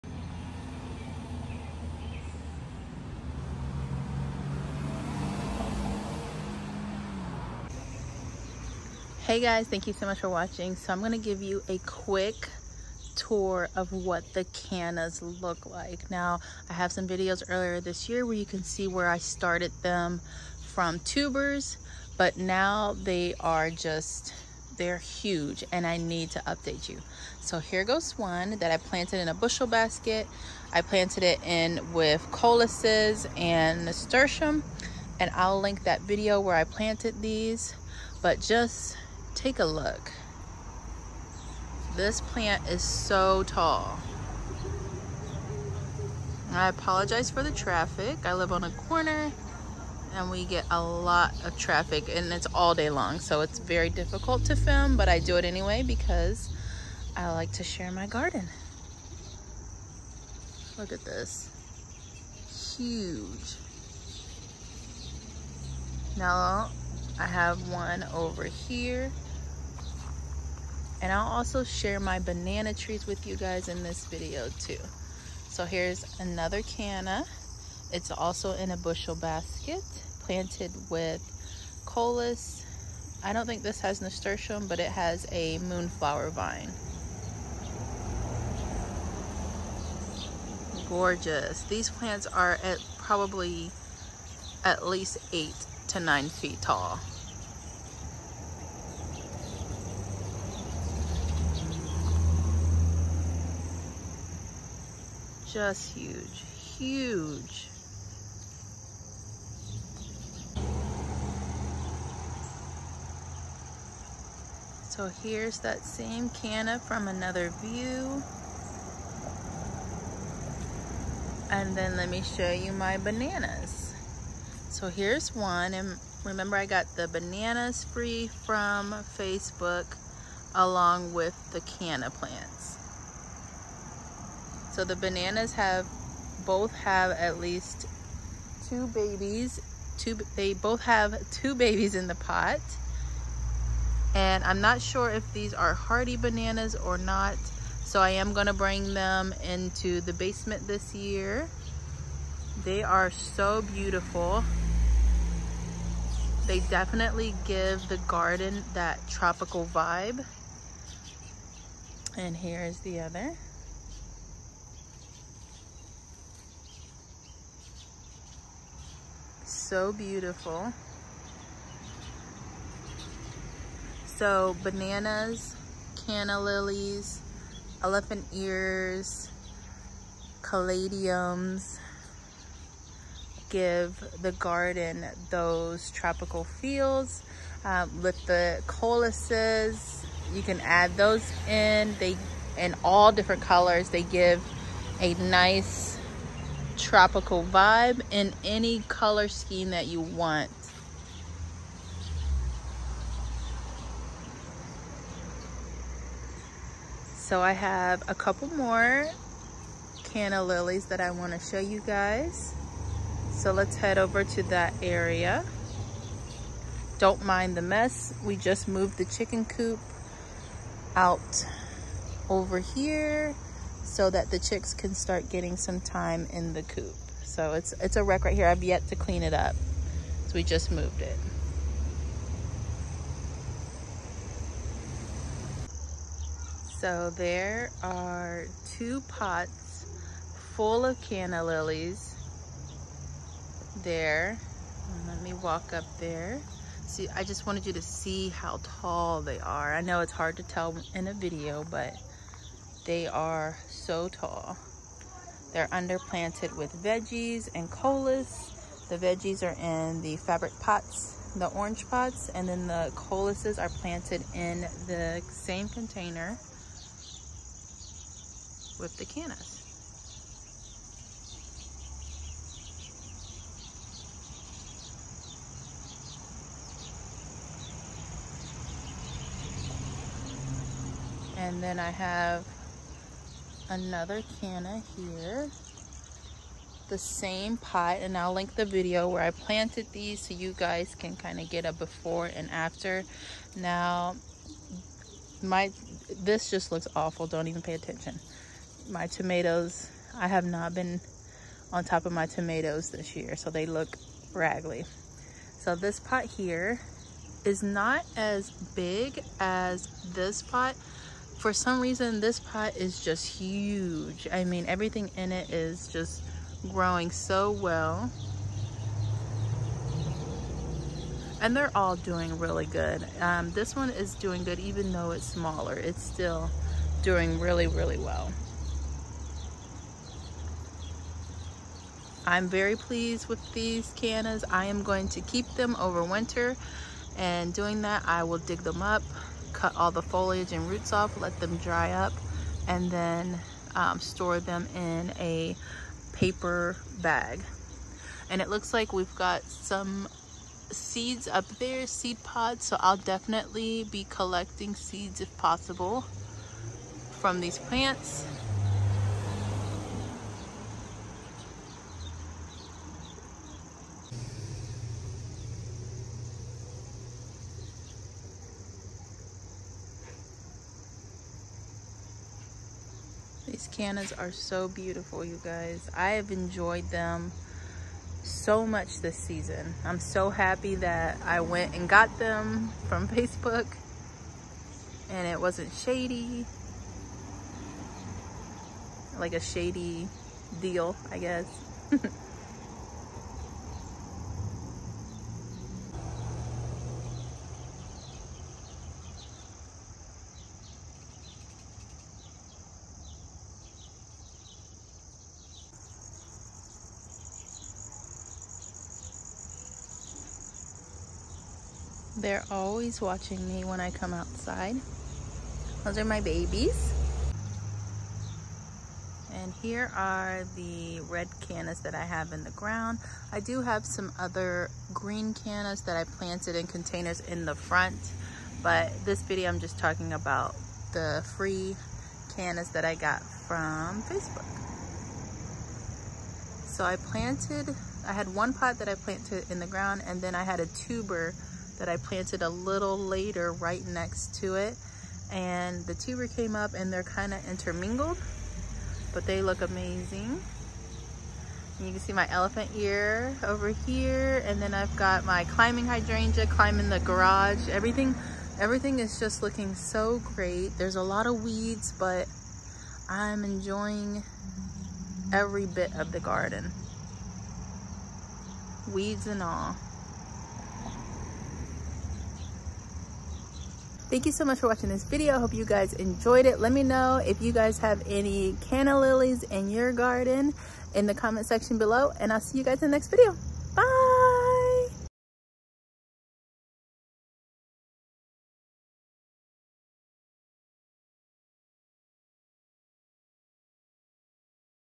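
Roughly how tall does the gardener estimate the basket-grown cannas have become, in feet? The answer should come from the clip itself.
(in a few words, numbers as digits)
8 to 9 feet.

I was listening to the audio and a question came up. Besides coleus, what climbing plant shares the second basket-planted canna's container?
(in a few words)
Moonflower vine.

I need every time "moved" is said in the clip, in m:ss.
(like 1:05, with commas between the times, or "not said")
3:38, 3:50.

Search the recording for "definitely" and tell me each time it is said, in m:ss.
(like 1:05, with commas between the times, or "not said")
2:36, 5:52.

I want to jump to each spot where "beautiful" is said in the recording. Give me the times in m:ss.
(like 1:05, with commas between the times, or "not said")
2:33, 2:49, 6:14.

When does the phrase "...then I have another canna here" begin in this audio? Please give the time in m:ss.
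4:41.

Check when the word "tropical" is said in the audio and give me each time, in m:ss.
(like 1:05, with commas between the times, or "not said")
2:39, 3:05, 3:16.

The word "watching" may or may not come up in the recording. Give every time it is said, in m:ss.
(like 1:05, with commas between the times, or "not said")
0:10, 6:53, 7:54.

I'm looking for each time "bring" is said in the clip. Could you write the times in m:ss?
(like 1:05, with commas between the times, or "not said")
2:28.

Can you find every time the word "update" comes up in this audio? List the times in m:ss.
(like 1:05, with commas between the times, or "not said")
0:26.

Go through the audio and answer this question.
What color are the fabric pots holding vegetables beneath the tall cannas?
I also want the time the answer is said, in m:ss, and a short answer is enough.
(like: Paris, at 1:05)
Orange, at 4:21.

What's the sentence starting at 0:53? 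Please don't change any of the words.
So it's very difficult to film, but I do it anyway because I like to share my garden.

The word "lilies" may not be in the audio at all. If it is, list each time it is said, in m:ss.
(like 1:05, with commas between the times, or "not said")
2:56, 3:30, 4:01, 7:58.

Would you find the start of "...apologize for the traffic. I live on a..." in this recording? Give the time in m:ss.
0:46.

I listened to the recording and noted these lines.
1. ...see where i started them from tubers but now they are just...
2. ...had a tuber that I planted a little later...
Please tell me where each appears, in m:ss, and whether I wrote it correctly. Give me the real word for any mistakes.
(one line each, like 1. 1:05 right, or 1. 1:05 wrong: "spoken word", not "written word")
1. 0:18 right
2. 7:20 right.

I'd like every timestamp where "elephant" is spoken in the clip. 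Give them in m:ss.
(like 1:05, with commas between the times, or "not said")
2:57, 7:32.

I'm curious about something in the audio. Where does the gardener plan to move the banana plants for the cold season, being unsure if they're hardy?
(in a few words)
The basement.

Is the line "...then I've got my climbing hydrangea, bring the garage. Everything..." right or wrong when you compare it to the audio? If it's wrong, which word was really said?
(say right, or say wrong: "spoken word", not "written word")
wrong: "climbing", not "bring".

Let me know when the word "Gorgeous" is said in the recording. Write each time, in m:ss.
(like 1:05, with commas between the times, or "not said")
1:30.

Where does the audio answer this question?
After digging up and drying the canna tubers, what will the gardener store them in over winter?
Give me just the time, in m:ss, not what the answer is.
5:46.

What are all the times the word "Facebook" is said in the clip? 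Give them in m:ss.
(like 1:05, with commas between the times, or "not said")
2:09, 6:23, 7:14.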